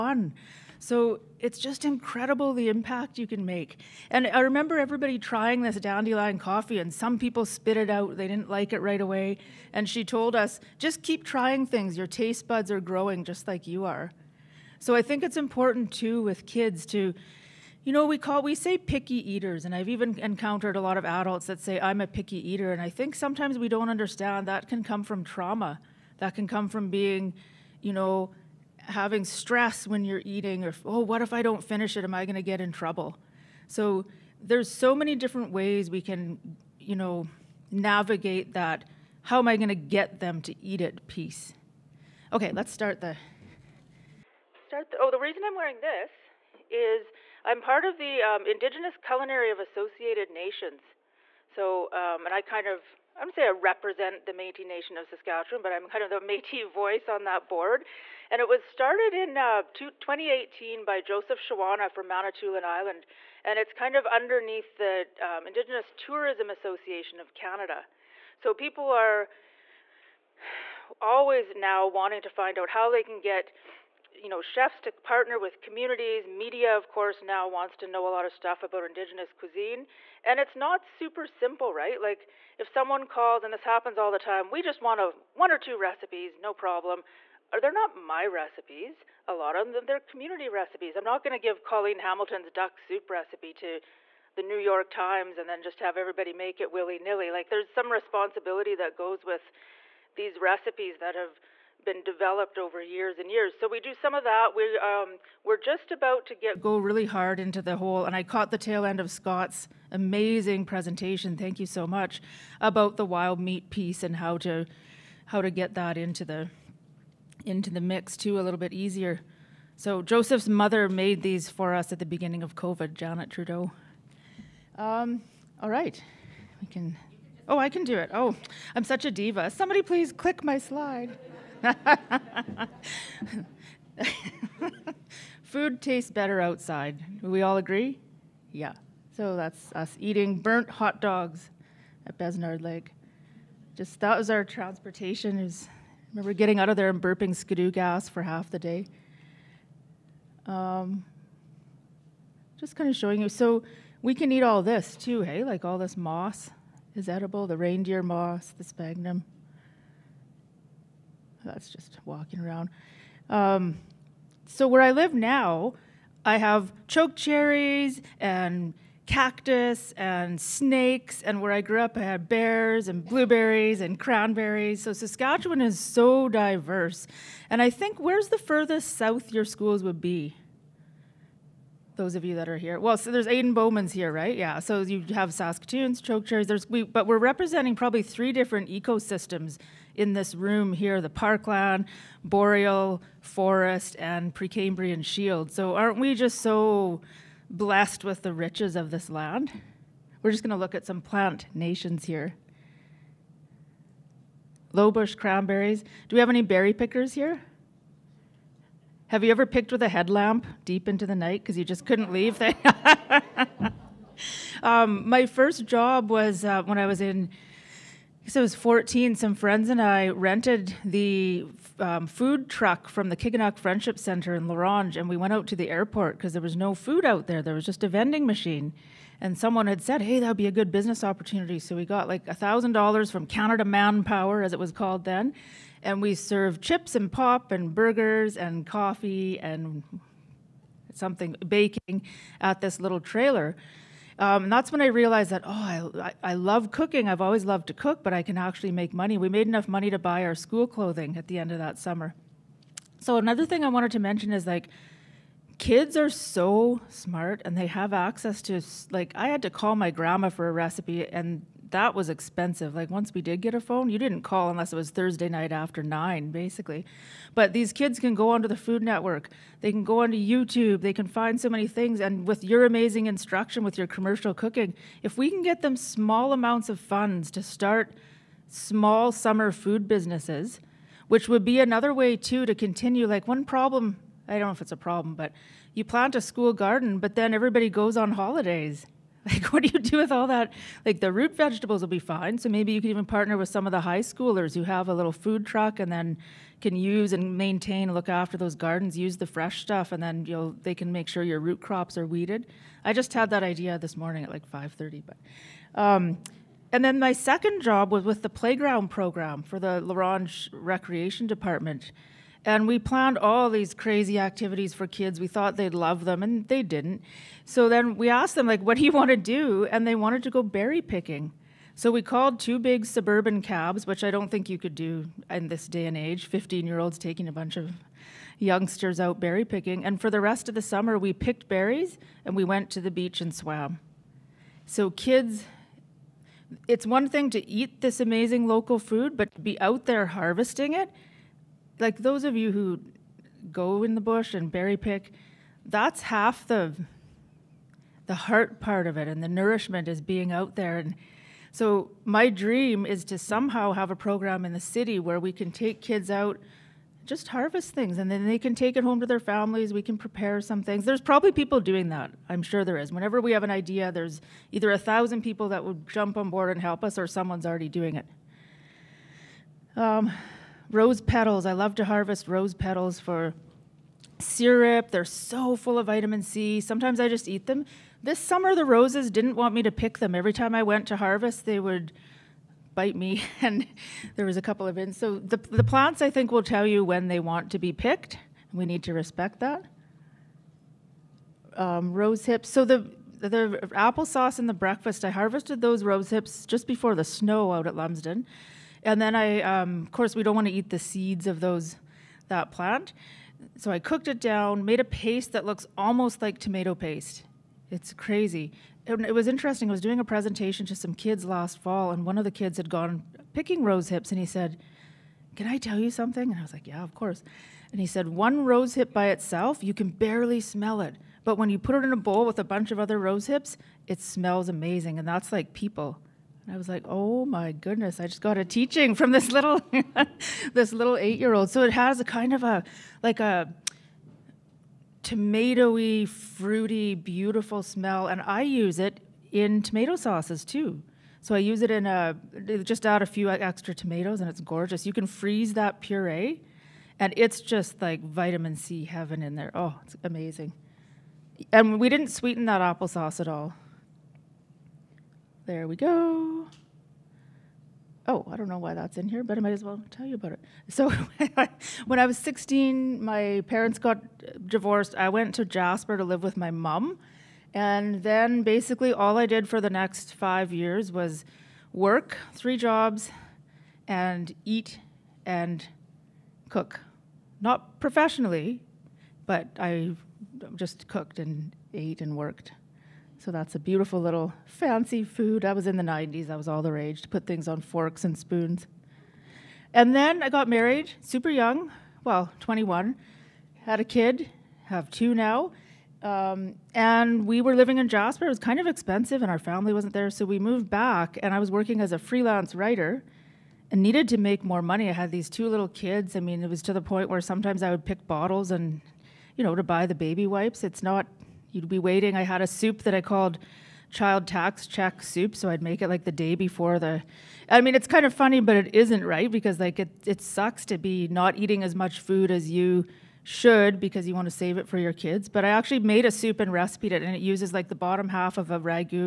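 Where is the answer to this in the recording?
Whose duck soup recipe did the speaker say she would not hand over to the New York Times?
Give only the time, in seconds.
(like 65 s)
91 s.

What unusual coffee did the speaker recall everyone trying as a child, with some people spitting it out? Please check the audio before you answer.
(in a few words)
Dandelion coffee.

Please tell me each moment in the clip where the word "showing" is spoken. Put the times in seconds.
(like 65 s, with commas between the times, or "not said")
152 s.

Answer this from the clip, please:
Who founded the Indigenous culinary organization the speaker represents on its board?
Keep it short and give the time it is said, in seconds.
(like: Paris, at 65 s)
Joseph Shawana, at 60 s.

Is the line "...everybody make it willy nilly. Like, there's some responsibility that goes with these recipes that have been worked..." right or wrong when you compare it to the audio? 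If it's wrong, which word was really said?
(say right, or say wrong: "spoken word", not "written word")
wrong: "developed", not "worked".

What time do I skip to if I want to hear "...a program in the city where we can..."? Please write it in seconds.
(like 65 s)
353 s.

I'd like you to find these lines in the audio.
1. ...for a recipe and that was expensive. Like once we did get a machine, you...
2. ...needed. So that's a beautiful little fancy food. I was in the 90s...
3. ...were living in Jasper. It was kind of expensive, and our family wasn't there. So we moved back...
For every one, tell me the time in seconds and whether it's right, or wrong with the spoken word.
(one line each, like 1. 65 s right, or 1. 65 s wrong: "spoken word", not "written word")
1. 260 s wrong: "phone", not "machine"
2. 482 s wrong: "worked", not "needed"
3. 497 s right.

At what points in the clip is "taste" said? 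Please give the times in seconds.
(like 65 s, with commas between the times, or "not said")
12 s, 135 s.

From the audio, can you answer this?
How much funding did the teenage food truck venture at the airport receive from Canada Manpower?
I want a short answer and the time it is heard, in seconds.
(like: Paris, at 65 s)
$1,000, at 232 s.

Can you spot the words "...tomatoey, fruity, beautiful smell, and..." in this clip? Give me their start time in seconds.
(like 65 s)
435 s.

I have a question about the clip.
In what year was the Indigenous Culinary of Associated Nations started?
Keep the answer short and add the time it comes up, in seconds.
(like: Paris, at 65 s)
2018, at 59 s.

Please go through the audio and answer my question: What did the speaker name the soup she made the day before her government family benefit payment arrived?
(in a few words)
Child tax check soup.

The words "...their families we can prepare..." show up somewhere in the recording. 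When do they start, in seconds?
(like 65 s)
359 s.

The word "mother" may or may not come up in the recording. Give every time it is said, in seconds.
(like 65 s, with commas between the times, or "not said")
120 s.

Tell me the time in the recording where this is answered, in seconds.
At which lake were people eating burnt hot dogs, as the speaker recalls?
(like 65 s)
142 s.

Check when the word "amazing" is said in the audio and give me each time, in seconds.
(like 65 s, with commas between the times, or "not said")
109 s, 272 s, 337 s, 424 s, 450 s.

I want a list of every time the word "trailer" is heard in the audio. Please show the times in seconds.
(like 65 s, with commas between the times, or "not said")
242 s.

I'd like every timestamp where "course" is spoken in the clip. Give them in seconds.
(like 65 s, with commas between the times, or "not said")
76 s, 399 s, 416 s.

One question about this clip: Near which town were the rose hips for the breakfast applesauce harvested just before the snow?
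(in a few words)
Lumsden.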